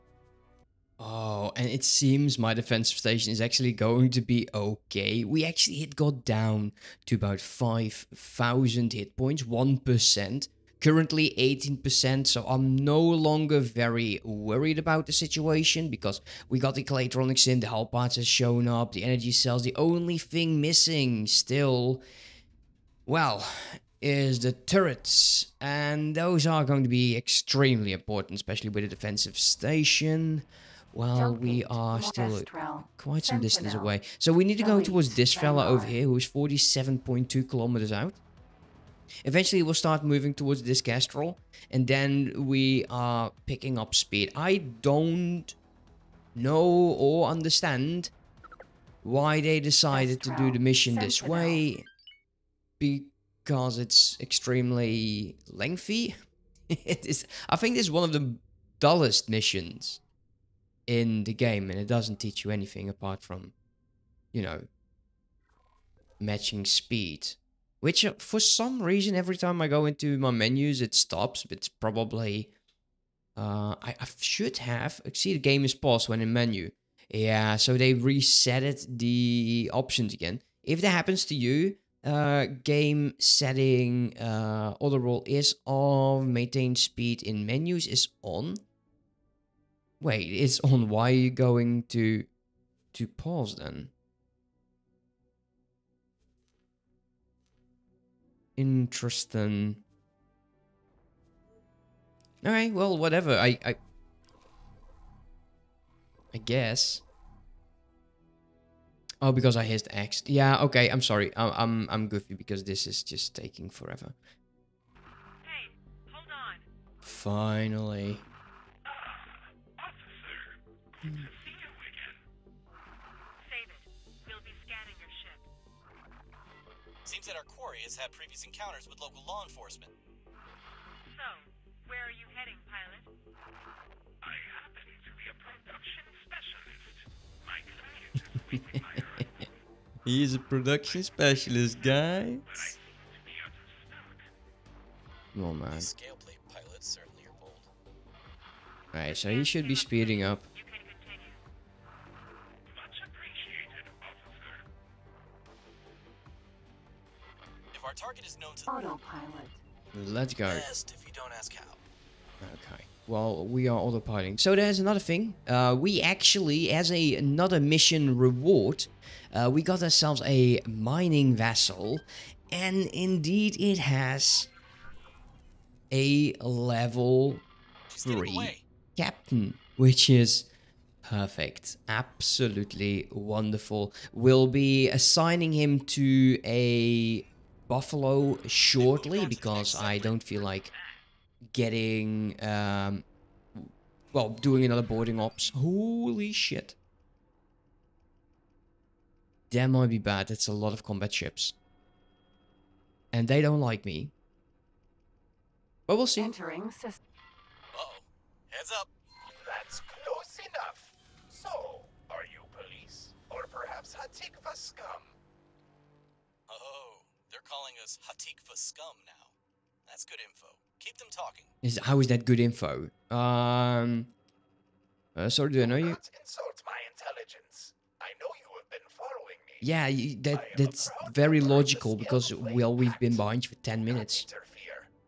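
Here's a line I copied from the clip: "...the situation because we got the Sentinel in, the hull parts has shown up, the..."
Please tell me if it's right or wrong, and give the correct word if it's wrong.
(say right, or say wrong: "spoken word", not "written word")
wrong: "Claytronics", not "Sentinel".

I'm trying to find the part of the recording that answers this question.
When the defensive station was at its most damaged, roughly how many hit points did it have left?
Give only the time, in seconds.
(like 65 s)
7 s.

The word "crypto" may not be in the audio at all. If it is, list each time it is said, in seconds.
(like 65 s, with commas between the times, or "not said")
not said.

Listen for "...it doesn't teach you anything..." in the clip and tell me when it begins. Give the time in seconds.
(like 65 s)
61 s.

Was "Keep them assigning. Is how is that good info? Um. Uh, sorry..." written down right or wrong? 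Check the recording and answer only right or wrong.
wrong.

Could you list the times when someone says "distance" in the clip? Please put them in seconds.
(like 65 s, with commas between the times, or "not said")
33 s.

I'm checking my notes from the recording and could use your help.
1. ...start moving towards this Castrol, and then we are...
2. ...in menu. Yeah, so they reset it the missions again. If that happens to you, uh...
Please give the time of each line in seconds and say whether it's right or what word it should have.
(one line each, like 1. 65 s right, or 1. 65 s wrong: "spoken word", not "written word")
1. 39 s right
2. 76 s wrong: "options", not "missions".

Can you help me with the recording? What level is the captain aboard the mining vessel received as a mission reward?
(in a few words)
Level 3.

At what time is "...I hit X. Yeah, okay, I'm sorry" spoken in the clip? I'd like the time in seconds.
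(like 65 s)
109 s.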